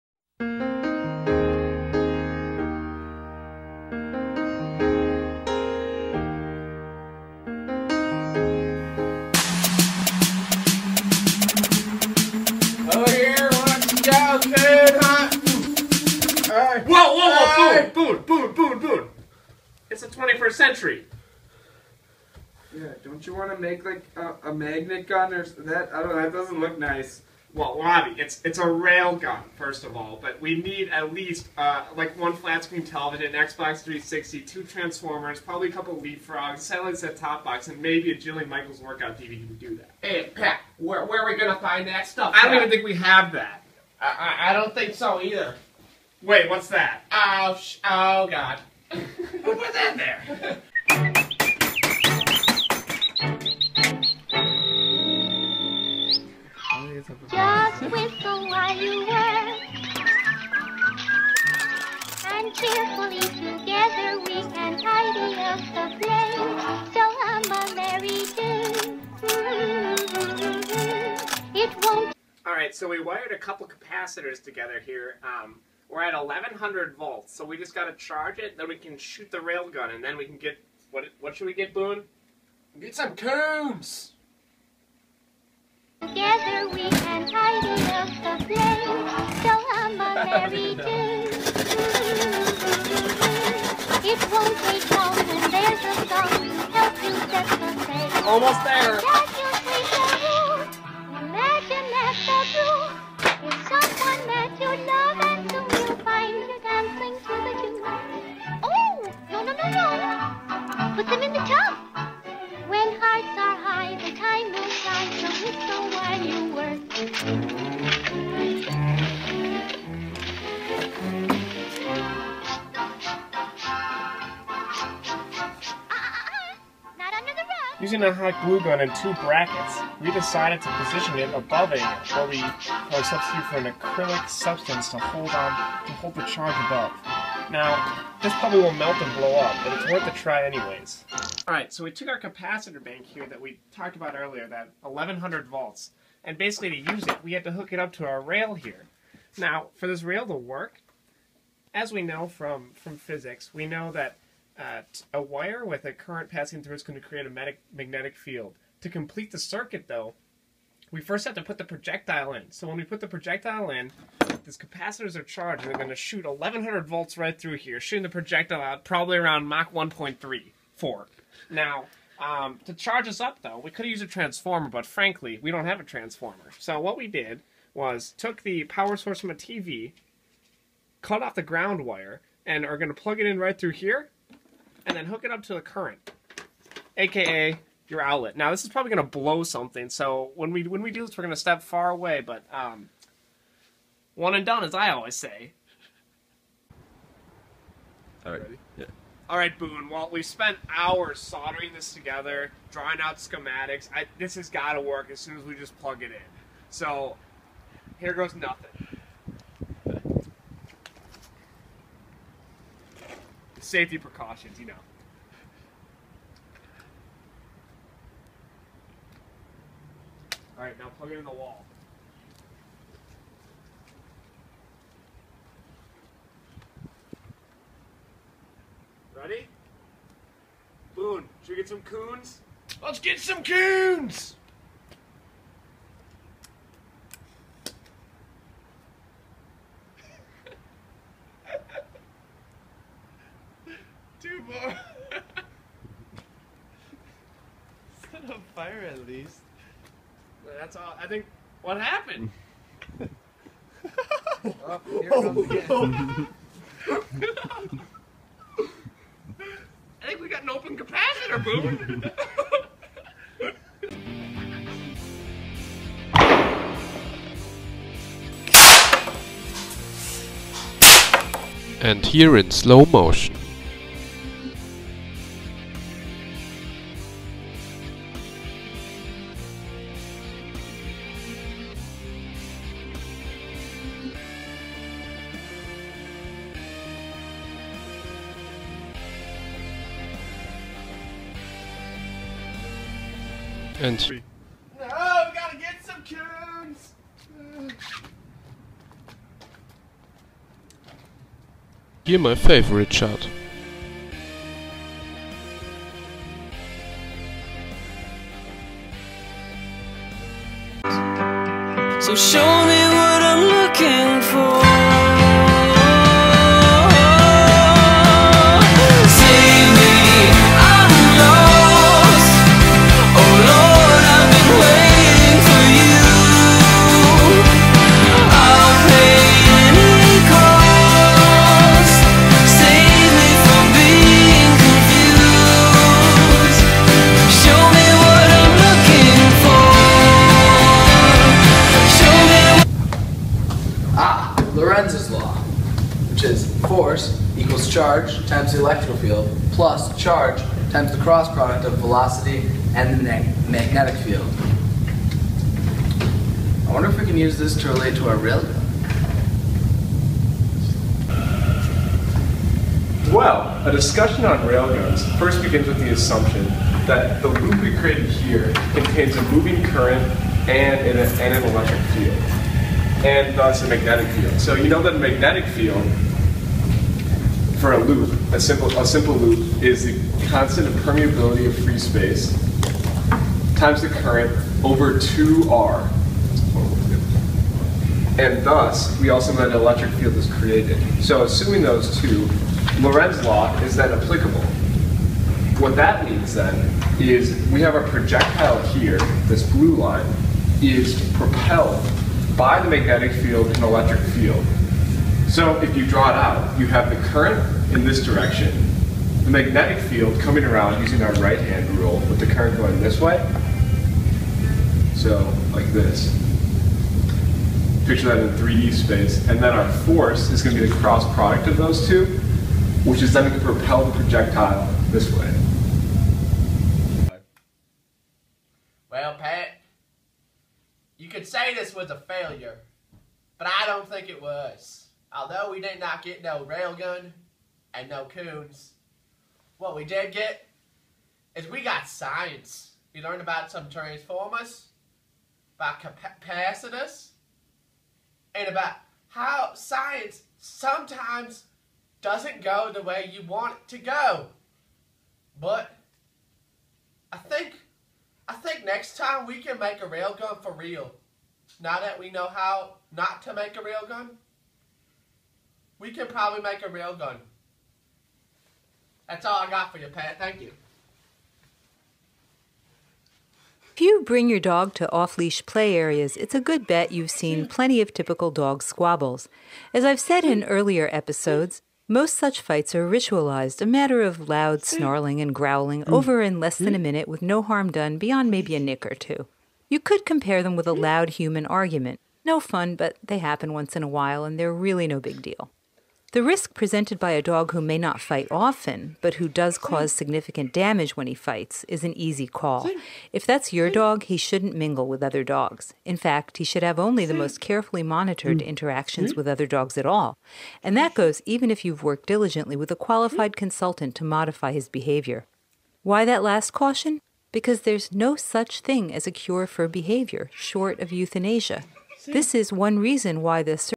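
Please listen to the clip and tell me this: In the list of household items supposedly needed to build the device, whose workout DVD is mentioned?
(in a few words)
Jillian Michaels.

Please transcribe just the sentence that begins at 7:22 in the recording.
We learned about some transformers, about capacitors, and about how science sometimes doesn't go the way you want it to go.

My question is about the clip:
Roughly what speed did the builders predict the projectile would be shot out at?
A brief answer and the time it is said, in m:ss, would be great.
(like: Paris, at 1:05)
Mach 1.3, at 2:49.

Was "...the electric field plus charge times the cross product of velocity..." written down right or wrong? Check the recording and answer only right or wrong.
right.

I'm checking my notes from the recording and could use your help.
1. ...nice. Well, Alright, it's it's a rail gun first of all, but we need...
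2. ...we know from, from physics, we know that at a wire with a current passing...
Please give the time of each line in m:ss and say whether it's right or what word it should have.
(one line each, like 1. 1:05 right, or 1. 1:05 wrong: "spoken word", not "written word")
1. 0:26 wrong: "Robbie", not "Alright"
2. 2:31 right.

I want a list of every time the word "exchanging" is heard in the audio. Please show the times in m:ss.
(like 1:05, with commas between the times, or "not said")
not said.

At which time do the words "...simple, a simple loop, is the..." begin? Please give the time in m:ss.
6:18.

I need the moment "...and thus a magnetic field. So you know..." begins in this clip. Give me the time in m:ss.
6:13.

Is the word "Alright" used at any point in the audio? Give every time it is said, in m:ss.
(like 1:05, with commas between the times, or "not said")
1:12, 2:21.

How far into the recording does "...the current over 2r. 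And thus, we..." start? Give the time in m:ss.
6:23.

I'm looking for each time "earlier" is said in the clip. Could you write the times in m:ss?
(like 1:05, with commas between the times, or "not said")
2:24, 8:00.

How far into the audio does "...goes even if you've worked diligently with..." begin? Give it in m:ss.
8:30.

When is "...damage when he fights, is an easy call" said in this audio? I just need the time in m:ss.
8:20.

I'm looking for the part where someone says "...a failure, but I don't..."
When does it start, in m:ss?
7:11.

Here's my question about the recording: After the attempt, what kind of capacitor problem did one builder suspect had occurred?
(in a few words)
open capacitor.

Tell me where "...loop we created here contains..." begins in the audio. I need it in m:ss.
6:07.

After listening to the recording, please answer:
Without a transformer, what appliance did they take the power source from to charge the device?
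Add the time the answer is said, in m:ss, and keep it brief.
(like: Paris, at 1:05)
a TV, at 2:59.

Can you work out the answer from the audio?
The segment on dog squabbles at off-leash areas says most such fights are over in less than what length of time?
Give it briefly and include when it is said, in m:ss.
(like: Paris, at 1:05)
a minute, at 8:06.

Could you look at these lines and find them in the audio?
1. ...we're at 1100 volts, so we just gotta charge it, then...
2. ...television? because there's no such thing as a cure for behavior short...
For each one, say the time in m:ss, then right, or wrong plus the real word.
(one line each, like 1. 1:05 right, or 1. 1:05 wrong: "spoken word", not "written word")
1. 1:15 right
2. 8:36 wrong: "caution", not "television".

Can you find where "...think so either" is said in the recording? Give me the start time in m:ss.
0:44.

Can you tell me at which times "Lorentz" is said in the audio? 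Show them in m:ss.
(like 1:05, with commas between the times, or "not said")
5:44, 6:32.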